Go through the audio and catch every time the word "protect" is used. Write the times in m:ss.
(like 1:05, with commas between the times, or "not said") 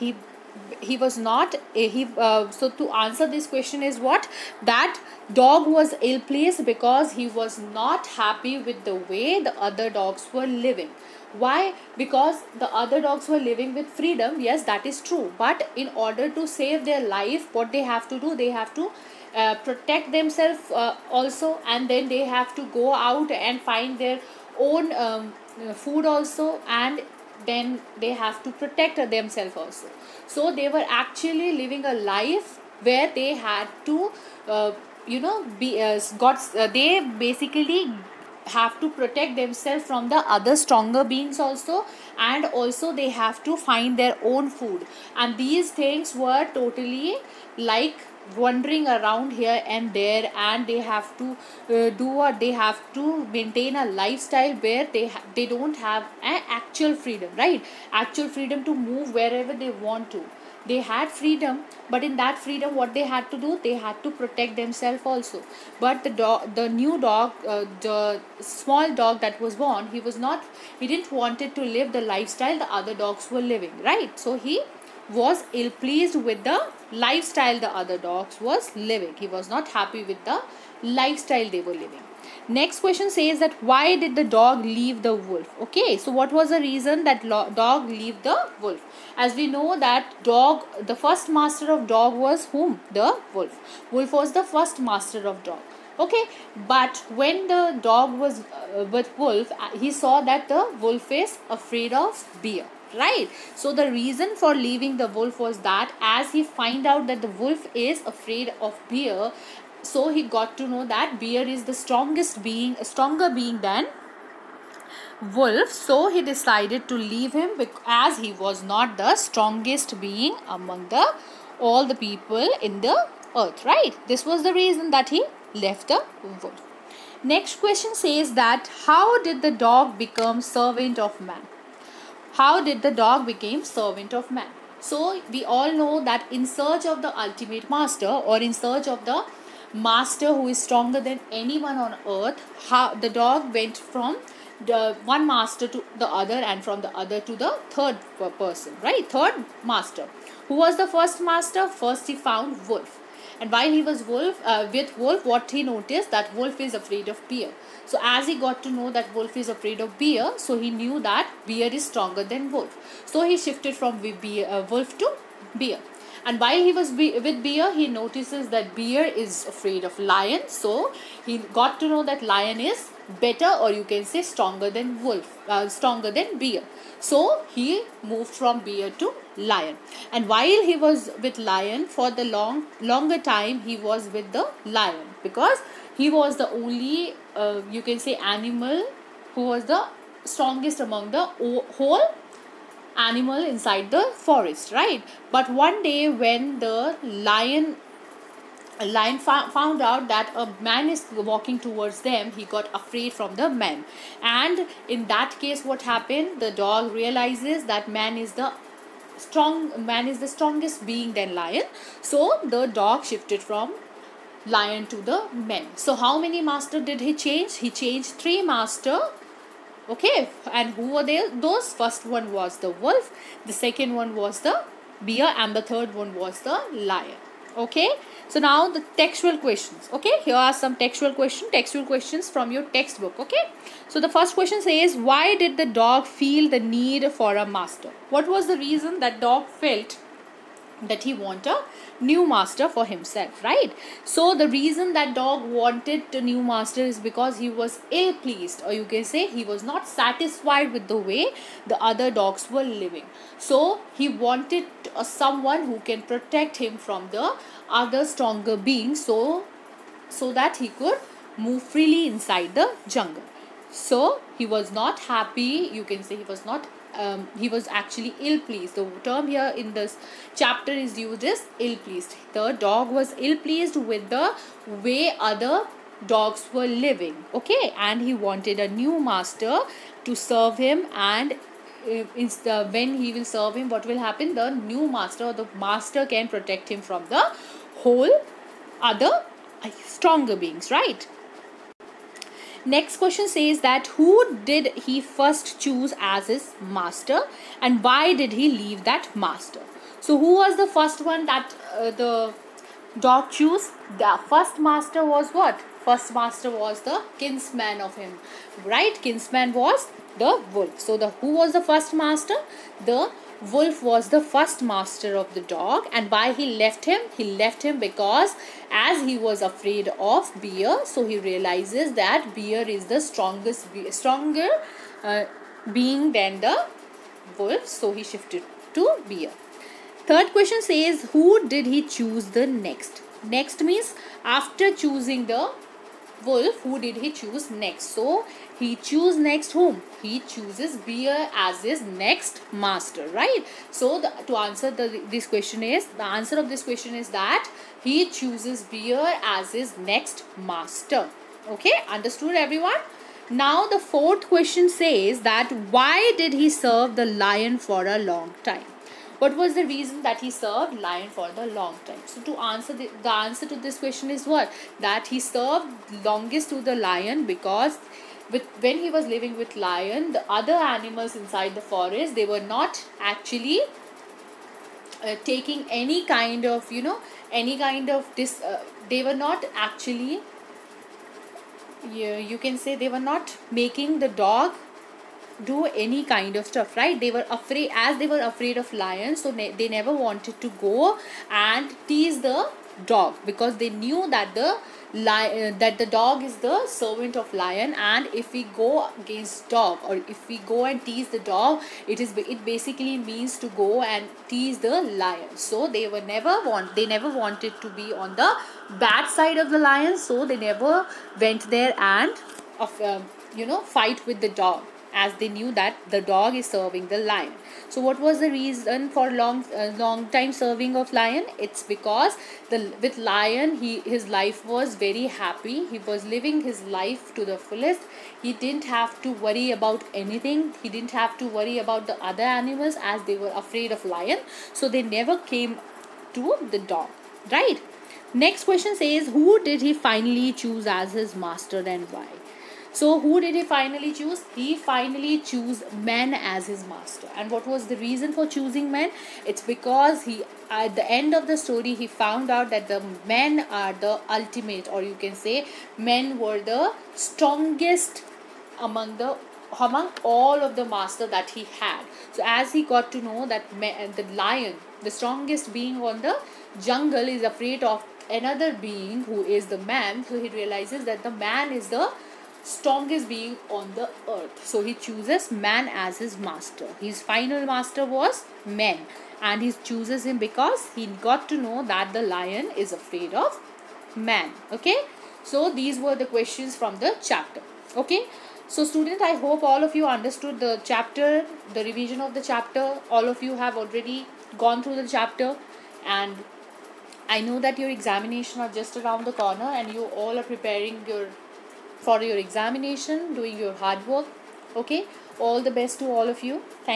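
0:19, 0:28, 0:38, 1:04, 4:16, 4:46.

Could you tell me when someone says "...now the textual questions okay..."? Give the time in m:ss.
3:48.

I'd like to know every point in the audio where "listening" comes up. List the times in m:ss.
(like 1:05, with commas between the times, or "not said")
not said.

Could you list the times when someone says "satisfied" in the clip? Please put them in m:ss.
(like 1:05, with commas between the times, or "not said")
4:09.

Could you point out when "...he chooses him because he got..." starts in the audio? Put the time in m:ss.
7:59.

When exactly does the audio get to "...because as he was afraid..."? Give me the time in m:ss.
5:17.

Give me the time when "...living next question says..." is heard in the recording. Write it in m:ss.
1:21.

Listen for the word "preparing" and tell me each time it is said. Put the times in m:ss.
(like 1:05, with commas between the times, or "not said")
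8:20.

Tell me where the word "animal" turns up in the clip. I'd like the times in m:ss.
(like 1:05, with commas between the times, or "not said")
3:08, 3:13, 6:10, 7:12.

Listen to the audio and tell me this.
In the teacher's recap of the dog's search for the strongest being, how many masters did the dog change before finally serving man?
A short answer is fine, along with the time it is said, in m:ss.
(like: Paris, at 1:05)
3, at 3:38.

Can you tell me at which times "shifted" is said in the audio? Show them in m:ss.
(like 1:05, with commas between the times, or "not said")
2:43, 3:33, 5:28.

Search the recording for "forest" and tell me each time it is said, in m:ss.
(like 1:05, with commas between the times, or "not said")
3:14, 6:11.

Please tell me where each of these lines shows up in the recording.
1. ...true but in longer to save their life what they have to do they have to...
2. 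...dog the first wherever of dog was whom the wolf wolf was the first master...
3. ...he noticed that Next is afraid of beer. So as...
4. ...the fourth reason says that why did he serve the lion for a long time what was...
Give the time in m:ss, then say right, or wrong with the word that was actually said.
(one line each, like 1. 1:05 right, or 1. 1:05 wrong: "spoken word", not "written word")
1. 0:15 wrong: "order", not "longer"
2. 1:30 wrong: "master", not "wherever"
3. 2:35 wrong: "Wolf", not "Next"
4. 5:53 wrong: "question", not "reason".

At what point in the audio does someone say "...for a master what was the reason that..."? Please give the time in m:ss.
3:57.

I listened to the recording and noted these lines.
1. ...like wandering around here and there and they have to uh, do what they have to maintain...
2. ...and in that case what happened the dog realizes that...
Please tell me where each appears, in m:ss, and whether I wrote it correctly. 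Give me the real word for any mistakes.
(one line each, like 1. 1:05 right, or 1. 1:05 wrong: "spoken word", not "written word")
1. 0:47 right
2. 3:24 right.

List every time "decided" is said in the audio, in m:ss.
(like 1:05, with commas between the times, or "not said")
1:56.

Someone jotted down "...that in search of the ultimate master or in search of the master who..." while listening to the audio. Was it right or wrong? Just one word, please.
right.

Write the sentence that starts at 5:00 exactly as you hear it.
So who was the first one that uh, the dog chose?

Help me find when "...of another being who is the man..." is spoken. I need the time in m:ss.
7:47.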